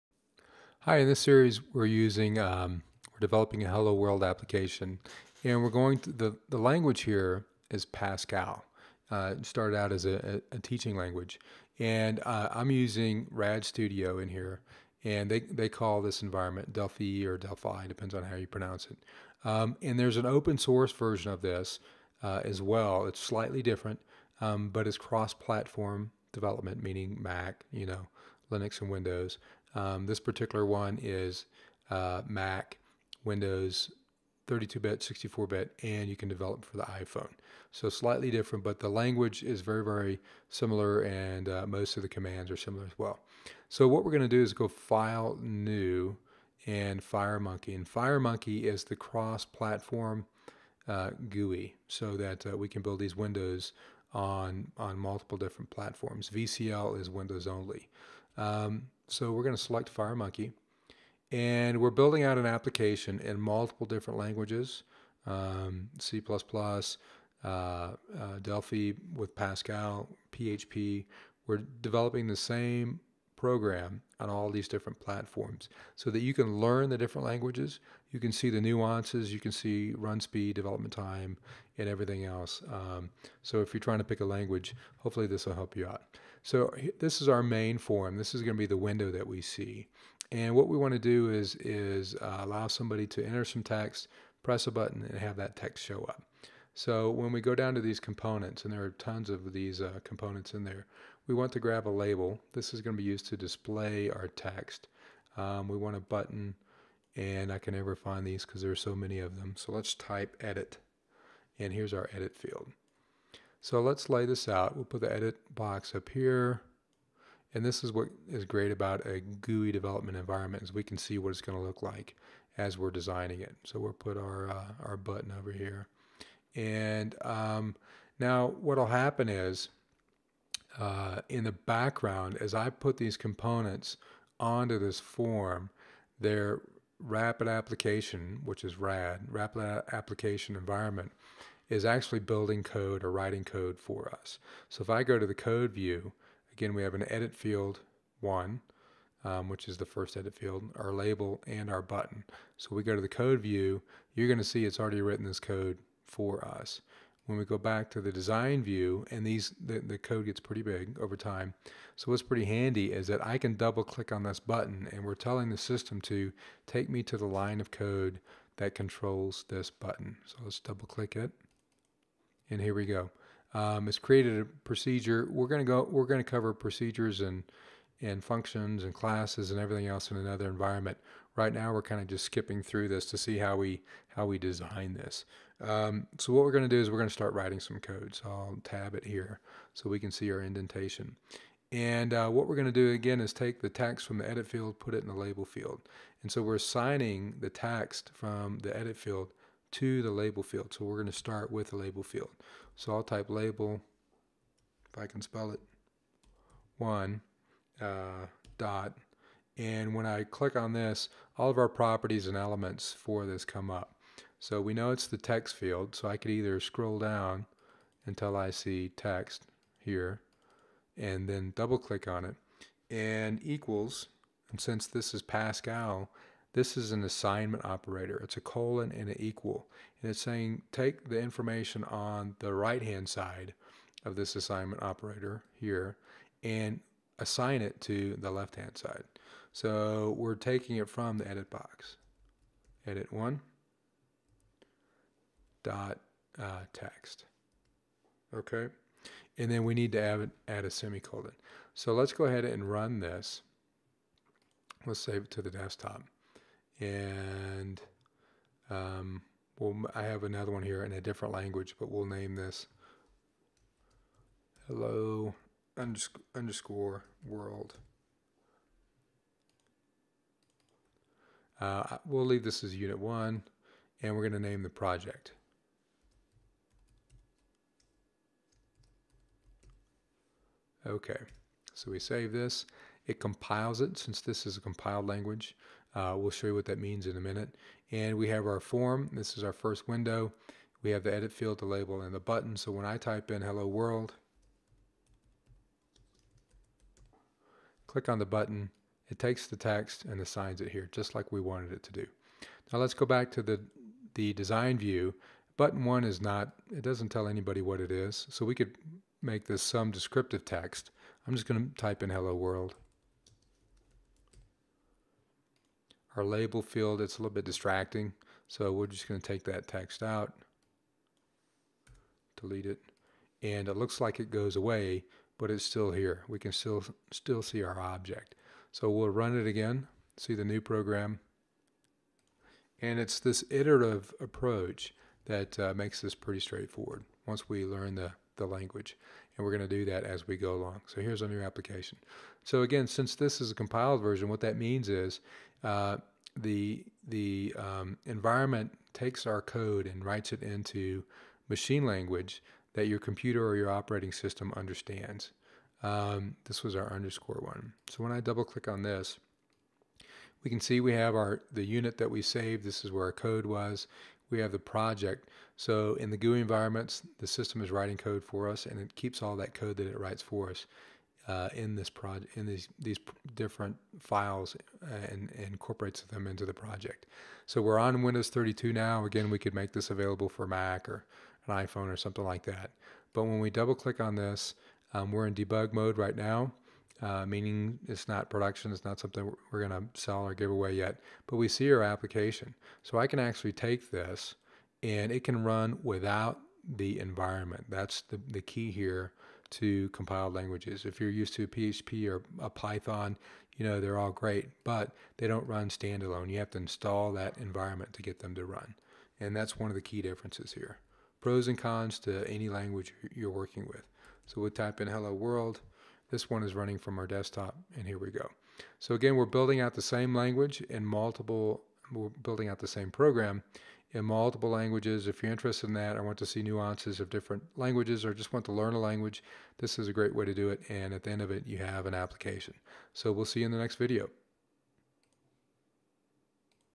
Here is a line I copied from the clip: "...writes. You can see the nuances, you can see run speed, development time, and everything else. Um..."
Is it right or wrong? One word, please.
wrong.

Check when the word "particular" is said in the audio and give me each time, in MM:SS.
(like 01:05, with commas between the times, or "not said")
00:30.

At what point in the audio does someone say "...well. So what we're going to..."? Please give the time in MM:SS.
00:42.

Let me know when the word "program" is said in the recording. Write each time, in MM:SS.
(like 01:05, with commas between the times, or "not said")
01:13, 05:30, 07:02.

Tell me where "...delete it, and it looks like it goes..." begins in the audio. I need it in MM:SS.
05:22.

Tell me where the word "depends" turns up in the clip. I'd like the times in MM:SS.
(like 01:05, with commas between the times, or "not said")
00:17.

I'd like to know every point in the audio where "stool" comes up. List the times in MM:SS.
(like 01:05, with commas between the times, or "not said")
not said.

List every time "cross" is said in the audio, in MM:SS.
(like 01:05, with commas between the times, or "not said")
00:24, 00:48.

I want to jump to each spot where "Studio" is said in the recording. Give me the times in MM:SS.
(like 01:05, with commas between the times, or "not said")
00:13.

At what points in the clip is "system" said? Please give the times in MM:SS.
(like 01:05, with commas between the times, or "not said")
02:45, 05:54, 06:07.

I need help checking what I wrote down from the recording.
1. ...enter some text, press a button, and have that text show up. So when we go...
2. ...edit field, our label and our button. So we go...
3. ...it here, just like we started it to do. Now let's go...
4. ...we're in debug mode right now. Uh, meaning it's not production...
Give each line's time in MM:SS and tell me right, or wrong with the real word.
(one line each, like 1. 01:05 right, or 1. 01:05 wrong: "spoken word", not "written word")
1. 01:33 right
2. 02:30 right
3. 05:00 wrong: "wanted", not "started"
4. 06:25 right.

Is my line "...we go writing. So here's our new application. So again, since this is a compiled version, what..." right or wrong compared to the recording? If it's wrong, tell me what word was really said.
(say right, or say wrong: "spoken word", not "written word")
wrong: "along", not "writing".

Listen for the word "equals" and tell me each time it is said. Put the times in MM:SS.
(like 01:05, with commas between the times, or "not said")
03:43, 03:49.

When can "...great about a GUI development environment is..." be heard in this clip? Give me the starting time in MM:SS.
01:58.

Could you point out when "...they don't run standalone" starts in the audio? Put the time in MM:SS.
06:45.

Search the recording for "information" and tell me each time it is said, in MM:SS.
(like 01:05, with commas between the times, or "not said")
03:51.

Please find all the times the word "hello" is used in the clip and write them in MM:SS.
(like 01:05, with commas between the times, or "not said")
00:03, 04:24, 04:53, 05:12, 06:54.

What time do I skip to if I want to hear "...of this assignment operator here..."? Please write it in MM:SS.
03:54.